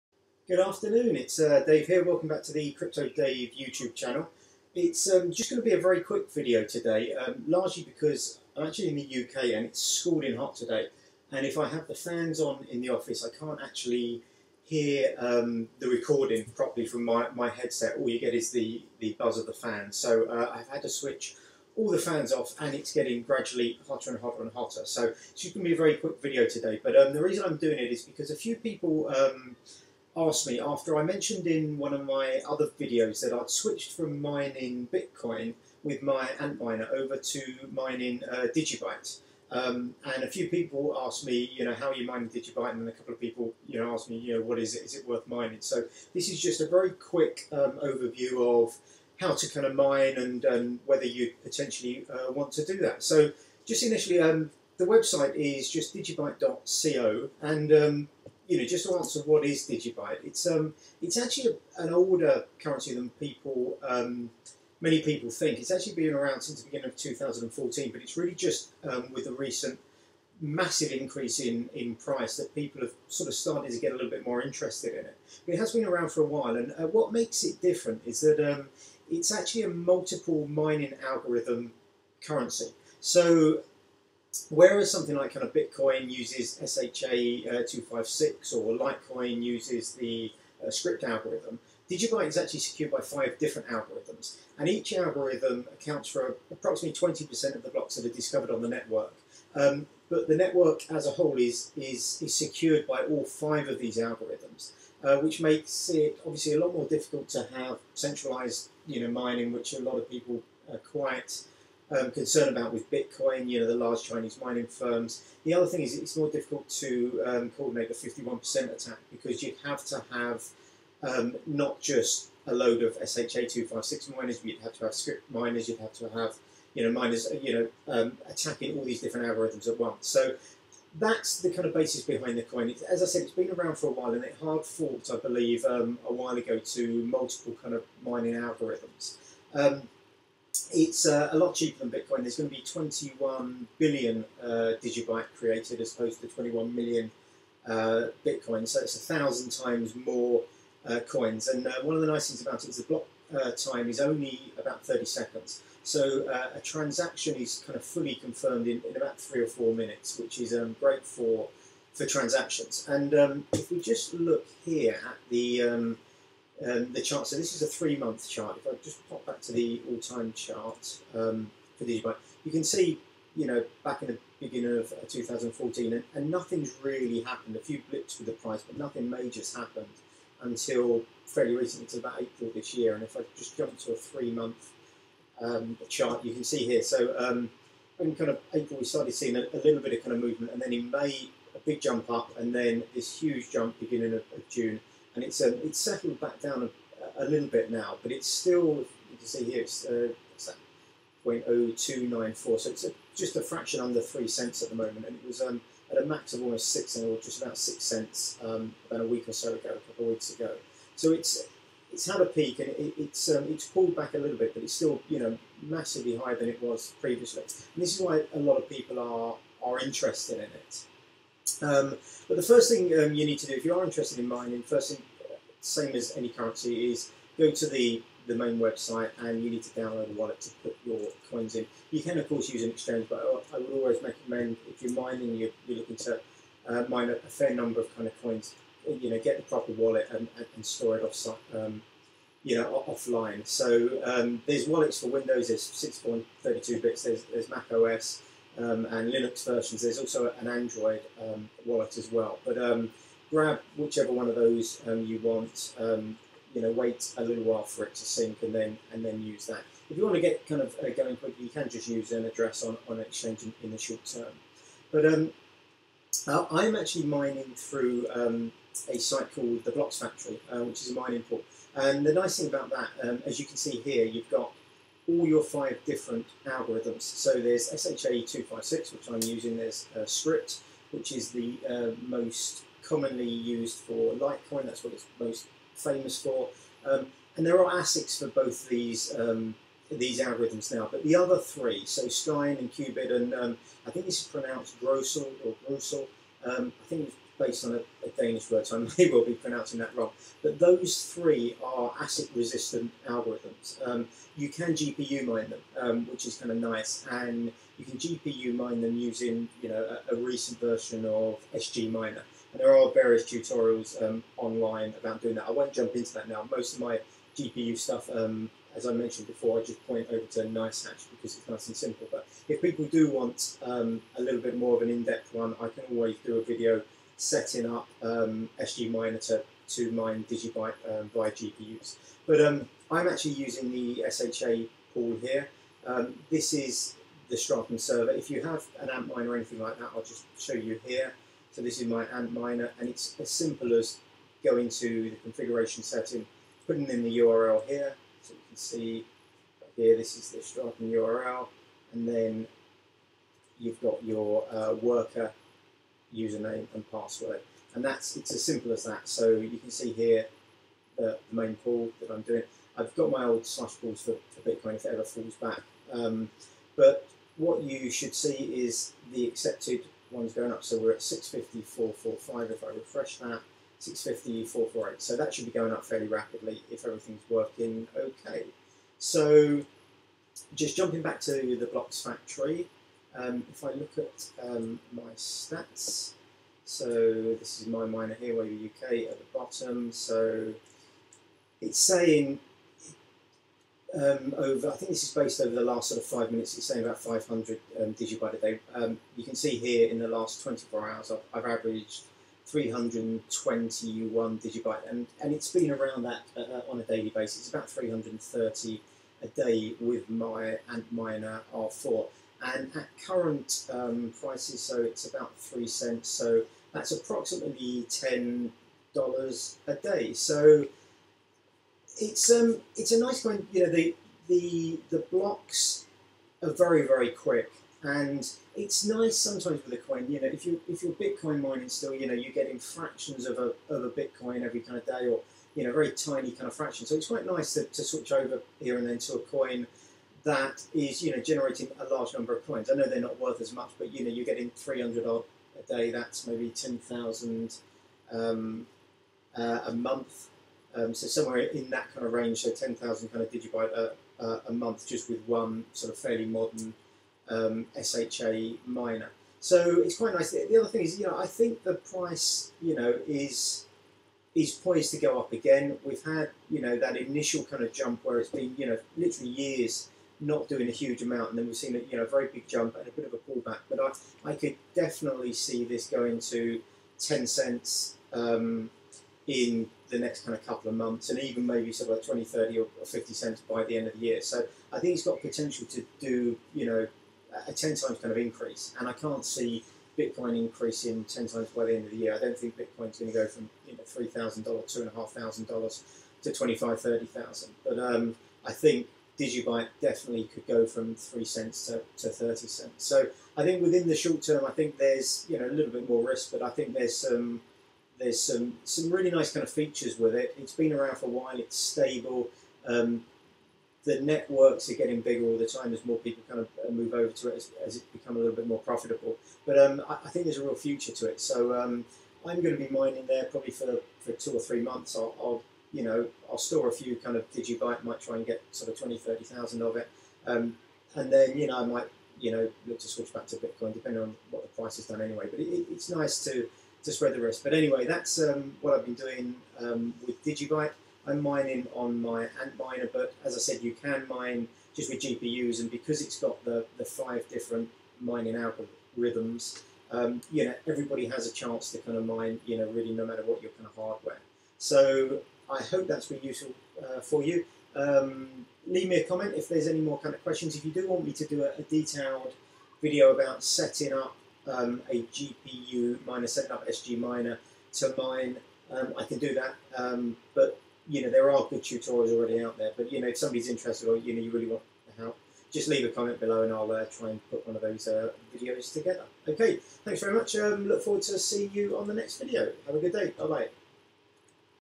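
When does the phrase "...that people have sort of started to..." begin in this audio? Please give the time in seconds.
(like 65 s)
72 s.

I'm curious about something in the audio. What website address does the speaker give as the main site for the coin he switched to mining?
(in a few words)
digibyte.co.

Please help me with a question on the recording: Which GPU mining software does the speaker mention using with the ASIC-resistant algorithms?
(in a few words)
SGMiner.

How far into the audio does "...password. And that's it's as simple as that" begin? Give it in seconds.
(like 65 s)
356 s.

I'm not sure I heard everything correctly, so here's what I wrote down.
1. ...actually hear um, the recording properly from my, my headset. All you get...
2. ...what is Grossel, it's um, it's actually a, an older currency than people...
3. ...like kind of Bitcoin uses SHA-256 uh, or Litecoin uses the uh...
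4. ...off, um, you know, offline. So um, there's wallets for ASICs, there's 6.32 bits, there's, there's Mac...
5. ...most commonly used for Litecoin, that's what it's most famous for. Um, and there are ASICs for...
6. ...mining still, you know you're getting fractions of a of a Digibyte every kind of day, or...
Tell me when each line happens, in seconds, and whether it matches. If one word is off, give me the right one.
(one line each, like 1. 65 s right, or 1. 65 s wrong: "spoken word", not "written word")
1. 13 s right
2. 59 s wrong: "Digibyte", not "Grossel"
3. 85 s right
4. 241 s wrong: "Windows", not "ASICs"
5. 282 s right
6. 431 s wrong: "Bitcoin", not "Digibyte".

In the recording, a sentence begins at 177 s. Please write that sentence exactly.
A few blips with the price, but nothing major's happened until fairly recently, to about April this year.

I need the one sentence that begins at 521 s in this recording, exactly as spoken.
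So um, I'm going to be mining there probably for for two or three months.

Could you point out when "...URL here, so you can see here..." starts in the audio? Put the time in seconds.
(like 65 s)
347 s.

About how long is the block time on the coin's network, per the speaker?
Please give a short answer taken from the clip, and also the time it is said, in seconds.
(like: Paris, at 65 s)
30 seconds, at 154 s.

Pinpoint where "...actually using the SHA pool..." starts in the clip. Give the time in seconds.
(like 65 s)
333 s.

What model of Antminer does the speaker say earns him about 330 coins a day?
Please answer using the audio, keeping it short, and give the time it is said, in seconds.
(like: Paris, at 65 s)
R4, at 410 s.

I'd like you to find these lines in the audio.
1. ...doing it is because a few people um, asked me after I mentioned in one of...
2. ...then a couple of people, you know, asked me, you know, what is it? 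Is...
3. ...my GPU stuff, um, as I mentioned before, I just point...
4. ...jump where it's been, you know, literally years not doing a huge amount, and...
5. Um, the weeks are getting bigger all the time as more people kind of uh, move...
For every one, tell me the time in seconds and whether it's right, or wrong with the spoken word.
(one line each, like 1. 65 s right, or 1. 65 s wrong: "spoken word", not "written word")
1. 27 s right
2. 42 s right
3. 316 s right
4. 467 s right
5. 512 s wrong: "networks", not "weeks".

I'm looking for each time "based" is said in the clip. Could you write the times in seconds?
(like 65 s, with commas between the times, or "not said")
297 s, 395 s.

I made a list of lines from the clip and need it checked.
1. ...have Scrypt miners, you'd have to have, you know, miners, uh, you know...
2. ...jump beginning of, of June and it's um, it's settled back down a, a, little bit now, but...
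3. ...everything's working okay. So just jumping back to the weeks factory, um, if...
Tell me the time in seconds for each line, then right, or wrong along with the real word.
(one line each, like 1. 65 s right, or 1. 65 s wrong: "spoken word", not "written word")
1. 124 s right
2. 193 s right
3. 376 s wrong: "blocks", not "weeks".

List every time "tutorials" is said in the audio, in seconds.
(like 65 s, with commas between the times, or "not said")
313 s, 571 s.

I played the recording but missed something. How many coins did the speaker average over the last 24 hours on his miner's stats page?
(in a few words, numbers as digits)
321.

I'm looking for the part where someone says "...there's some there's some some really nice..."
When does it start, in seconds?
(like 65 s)
506 s.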